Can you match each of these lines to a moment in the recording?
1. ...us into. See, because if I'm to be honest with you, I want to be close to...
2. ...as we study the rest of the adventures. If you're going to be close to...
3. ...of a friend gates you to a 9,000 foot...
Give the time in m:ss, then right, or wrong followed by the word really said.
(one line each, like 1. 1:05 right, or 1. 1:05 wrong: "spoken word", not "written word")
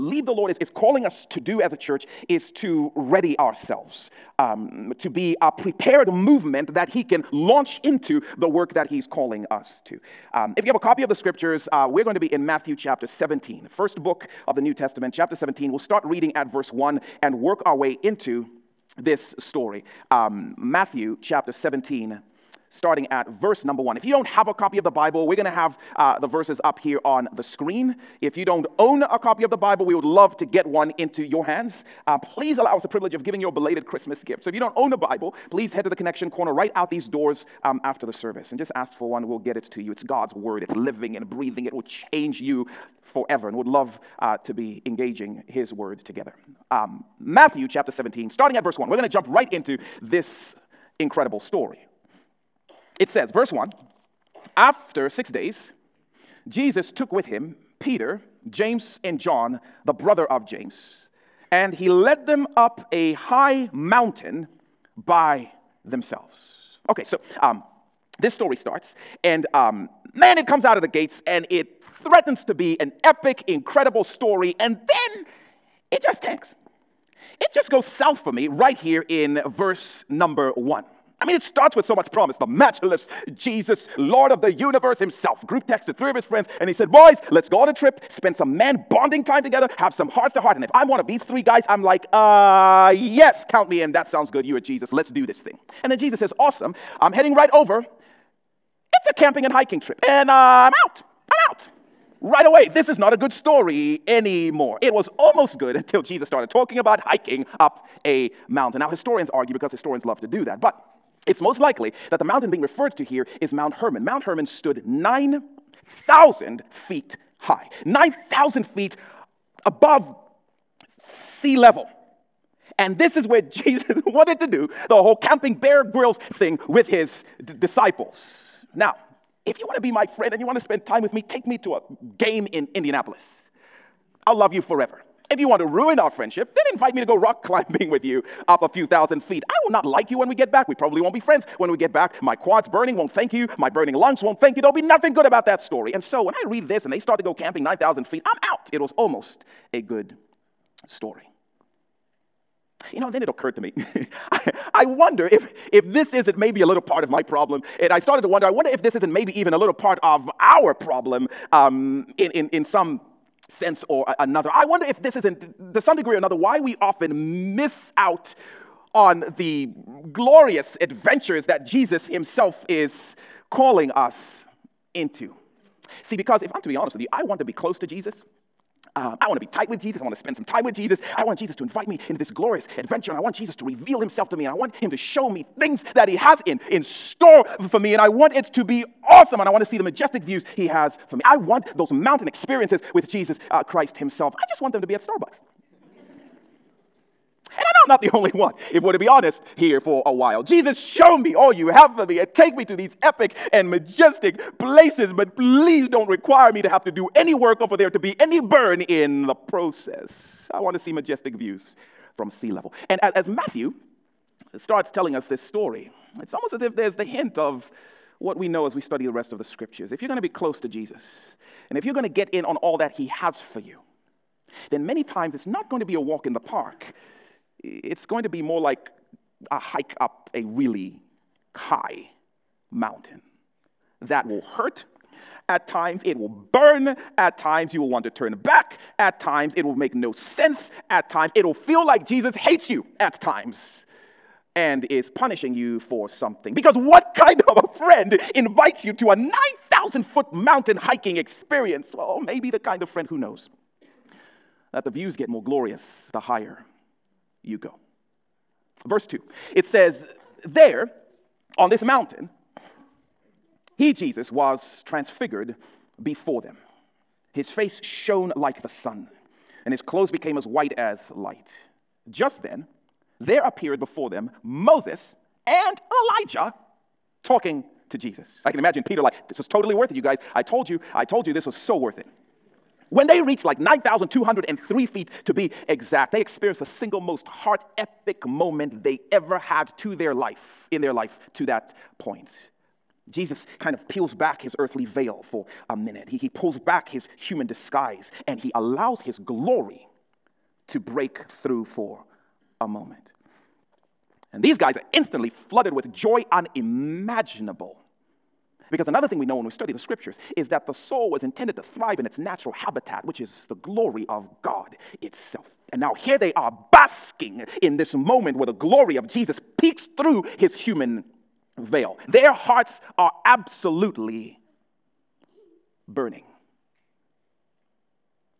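1. 2:53 right
2. 3:38 wrong: "scriptures", not "adventures"
3. 4:07 wrong: "invites", not "gates".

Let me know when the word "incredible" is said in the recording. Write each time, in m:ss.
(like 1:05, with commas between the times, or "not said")
0:50, 1:13.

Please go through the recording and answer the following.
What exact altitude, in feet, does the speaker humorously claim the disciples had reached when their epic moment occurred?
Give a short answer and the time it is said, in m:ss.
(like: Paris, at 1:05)
9,203 feet, at 4:43.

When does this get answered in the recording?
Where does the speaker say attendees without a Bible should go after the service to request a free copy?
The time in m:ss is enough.
0:35.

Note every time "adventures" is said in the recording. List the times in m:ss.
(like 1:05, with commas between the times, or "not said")
2:50, 3:02.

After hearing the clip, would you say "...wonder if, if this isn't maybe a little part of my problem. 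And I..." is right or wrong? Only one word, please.
right.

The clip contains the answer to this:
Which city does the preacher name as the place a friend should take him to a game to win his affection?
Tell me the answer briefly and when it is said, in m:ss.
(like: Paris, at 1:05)
Indianapolis, at 2:12.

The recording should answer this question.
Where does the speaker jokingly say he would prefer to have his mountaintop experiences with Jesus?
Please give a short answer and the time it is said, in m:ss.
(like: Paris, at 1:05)
Starbucks, at 3:15.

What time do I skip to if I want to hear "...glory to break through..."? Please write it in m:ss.
4:59.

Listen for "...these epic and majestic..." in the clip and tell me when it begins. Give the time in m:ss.
3:22.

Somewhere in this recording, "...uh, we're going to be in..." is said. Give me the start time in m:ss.
0:11.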